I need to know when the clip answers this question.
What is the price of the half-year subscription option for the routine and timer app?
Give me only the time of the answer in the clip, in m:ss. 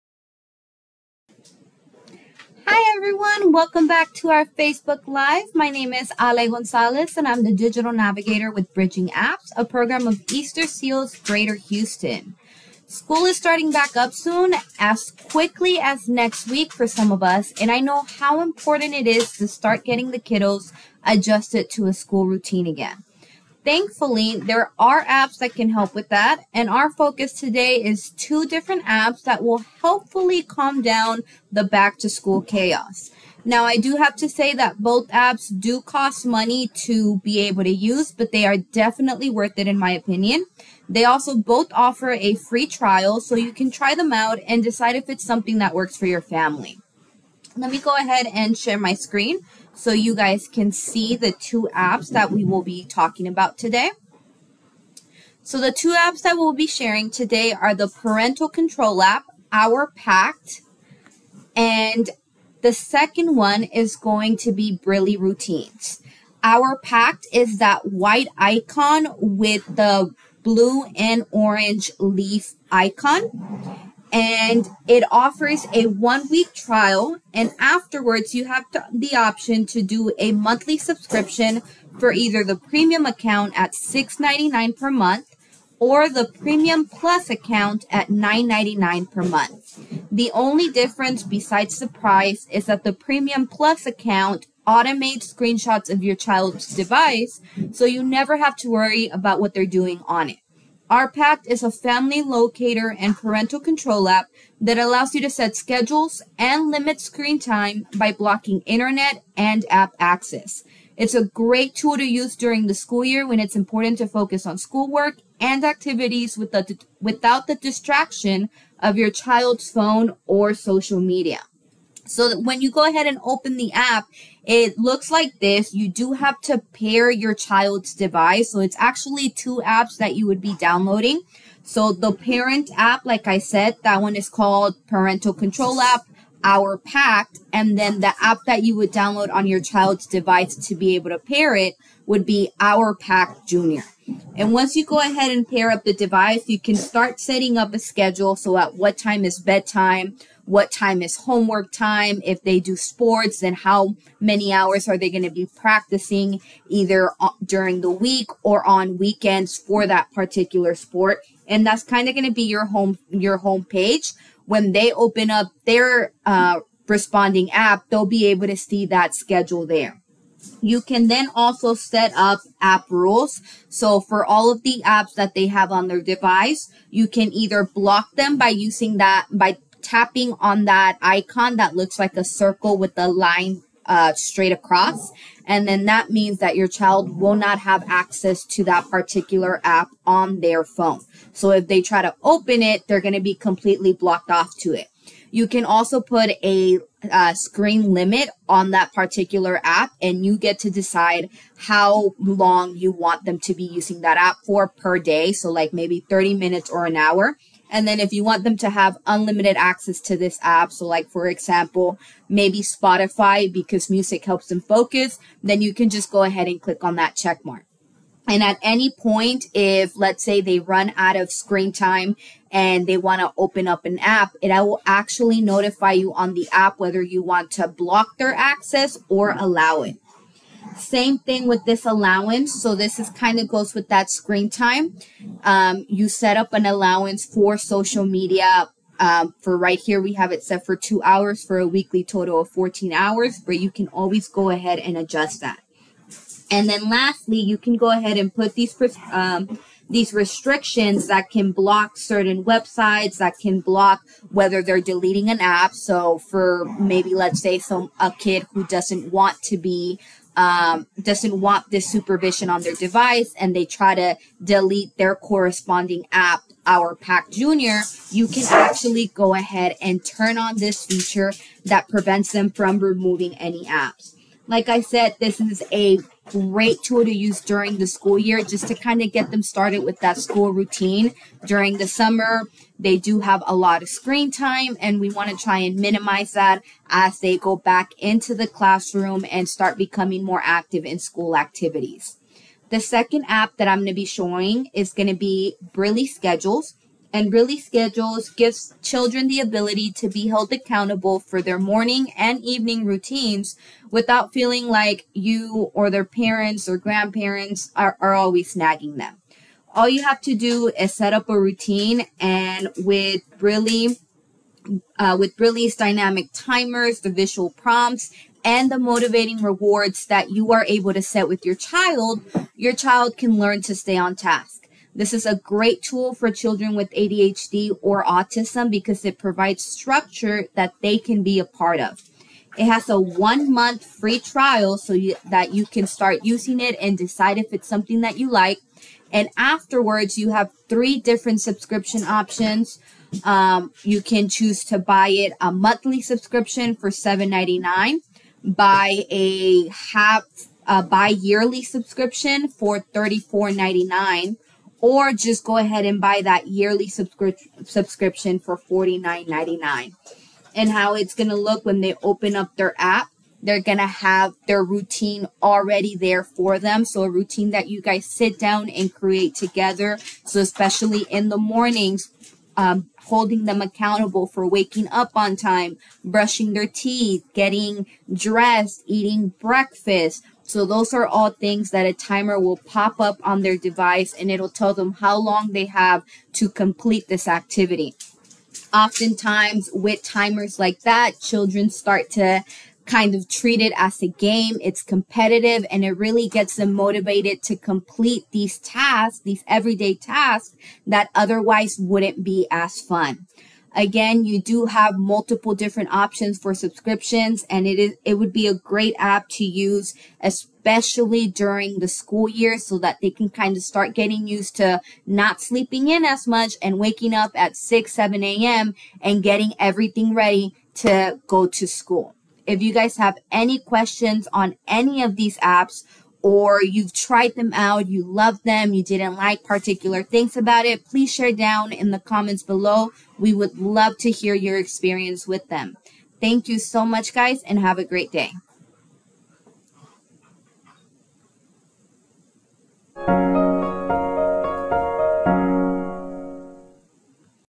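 5:52.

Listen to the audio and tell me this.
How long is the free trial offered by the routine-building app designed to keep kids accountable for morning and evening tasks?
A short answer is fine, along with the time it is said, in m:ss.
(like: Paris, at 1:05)
One month, at 5:32.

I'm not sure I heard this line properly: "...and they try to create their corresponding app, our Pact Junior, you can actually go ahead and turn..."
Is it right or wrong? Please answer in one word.
wrong.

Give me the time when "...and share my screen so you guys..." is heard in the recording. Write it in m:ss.
0:48.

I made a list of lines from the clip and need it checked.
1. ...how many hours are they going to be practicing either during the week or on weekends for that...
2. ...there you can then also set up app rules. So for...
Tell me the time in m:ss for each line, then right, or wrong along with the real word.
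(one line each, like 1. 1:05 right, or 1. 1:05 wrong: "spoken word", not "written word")
1. 2:33 right
2. 2:49 right.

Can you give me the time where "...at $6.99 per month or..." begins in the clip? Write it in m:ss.
1:23.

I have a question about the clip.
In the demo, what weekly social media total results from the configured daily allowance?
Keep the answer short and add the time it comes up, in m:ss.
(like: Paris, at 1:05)
14 hours, at 4:02.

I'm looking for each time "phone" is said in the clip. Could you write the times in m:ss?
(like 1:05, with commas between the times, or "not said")
1:59, 3:10.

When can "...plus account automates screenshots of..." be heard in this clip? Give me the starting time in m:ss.
1:33.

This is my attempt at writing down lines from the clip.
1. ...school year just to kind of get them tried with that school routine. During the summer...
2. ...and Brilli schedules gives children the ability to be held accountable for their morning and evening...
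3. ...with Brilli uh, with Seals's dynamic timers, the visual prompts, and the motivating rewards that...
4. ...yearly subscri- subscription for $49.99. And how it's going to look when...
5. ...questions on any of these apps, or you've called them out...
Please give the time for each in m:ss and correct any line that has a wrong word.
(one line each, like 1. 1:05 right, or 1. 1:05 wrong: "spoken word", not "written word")
1. 4:37 wrong: "started", not "tried"
2. 4:57 right
3. 5:12 wrong: "Brilli", not "Seals"
4. 5:56 right
5. 7:03 wrong: "tried", not "called".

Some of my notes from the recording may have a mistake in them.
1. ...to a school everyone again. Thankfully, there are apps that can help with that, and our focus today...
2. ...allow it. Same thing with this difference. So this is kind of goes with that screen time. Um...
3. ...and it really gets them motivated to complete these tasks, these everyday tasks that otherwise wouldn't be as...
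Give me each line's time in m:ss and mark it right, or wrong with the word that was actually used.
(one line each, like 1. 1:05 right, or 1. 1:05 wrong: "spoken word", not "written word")
1. 0:21 wrong: "routine", not "everyone"
2. 3:49 wrong: "allowance", not "difference"
3. 6:35 right.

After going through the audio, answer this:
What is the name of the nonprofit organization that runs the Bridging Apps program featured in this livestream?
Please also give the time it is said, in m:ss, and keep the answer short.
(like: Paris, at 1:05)
Easter Seals Greater Houston, at 0:10.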